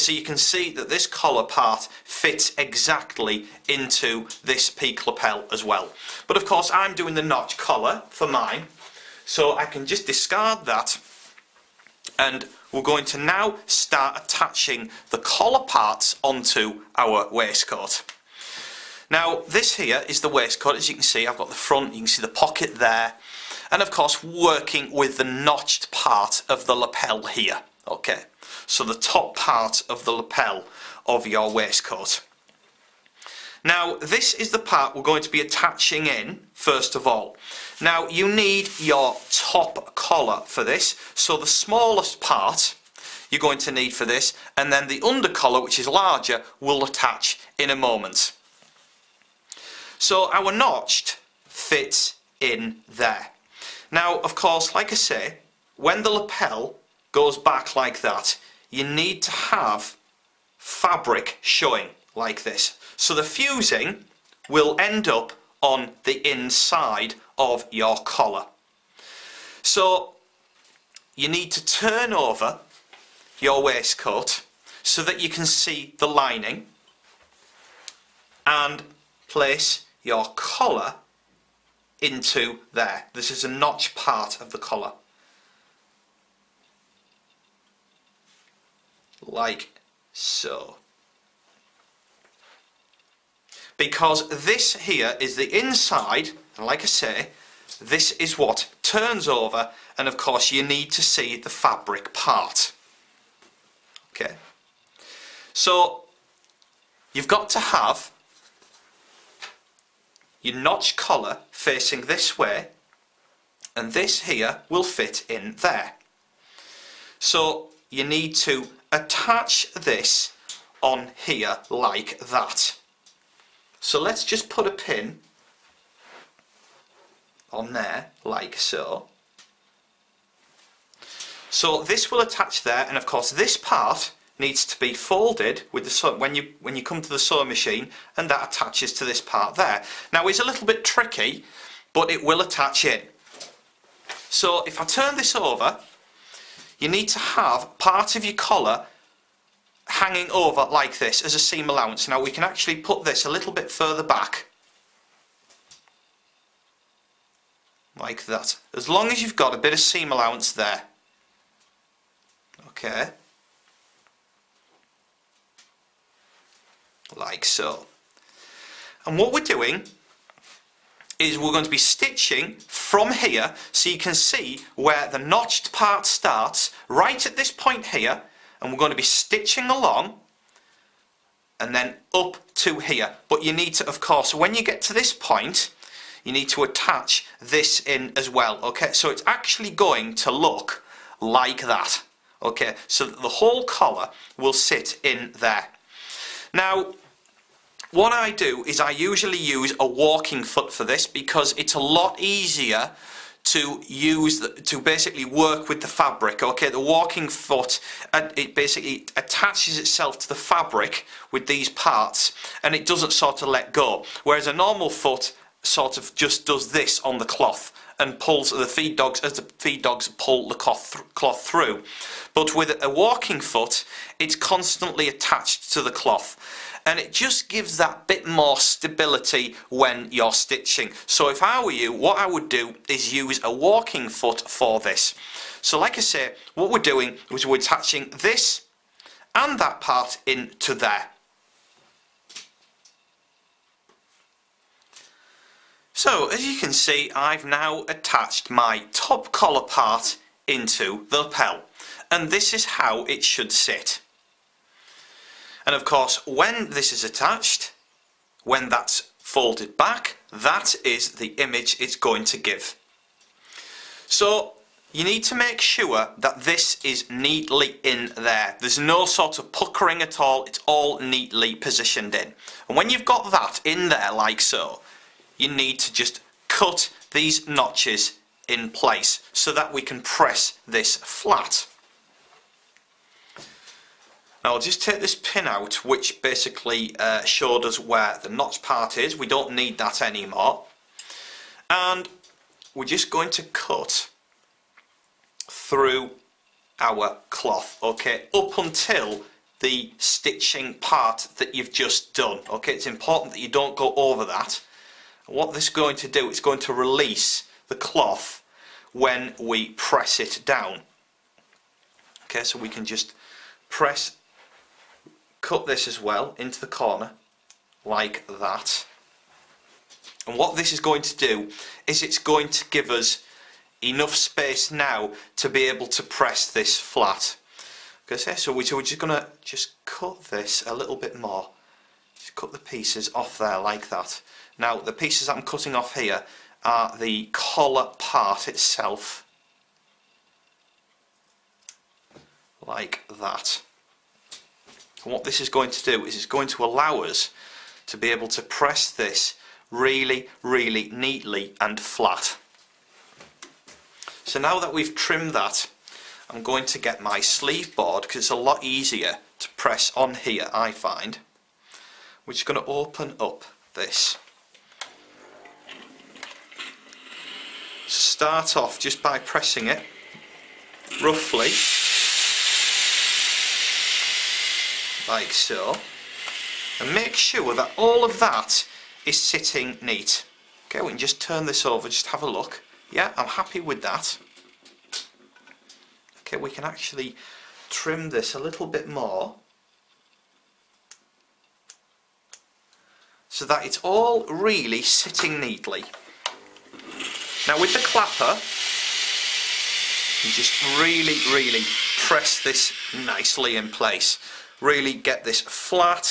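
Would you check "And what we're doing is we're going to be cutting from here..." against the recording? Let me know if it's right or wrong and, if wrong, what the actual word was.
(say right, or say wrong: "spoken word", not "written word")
wrong: "stitching", not "cutting".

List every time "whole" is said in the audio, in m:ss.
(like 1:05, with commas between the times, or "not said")
3:13.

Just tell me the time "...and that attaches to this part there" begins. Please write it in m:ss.
2:18.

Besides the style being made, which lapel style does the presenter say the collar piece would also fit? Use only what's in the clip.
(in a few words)
Peak lapel.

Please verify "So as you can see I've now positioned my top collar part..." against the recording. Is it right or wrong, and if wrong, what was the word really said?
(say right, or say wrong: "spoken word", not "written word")
wrong: "attached", not "positioned".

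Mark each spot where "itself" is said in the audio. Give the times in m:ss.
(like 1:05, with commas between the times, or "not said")
3:29, 5:38.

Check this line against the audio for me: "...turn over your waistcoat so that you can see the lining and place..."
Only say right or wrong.
right.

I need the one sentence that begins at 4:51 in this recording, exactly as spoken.
And we're just going to cut through our cloth, okay, up until the stitching part that you've just done, okay.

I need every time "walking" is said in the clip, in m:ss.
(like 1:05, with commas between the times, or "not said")
3:19, 3:26, 3:42, 3:53.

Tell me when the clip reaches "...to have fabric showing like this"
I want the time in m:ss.
0:59.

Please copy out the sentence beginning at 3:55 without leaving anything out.
So like I say, what we're doing is we're attaching this and that part into there.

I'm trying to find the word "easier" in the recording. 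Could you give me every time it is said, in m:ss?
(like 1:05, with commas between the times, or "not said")
3:22, 5:58.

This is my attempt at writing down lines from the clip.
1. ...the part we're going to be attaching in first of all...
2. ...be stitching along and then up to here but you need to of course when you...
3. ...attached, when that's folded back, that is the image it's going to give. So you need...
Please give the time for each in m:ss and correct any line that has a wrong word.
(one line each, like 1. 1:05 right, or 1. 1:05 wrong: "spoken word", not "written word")
1. 0:34 right
2. 2:58 right
3. 4:17 right.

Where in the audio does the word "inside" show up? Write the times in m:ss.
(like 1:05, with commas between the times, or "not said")
1:06, 1:35.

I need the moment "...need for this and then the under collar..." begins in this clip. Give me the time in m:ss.
0:43.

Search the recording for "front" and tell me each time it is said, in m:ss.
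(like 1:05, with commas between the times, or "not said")
0:21.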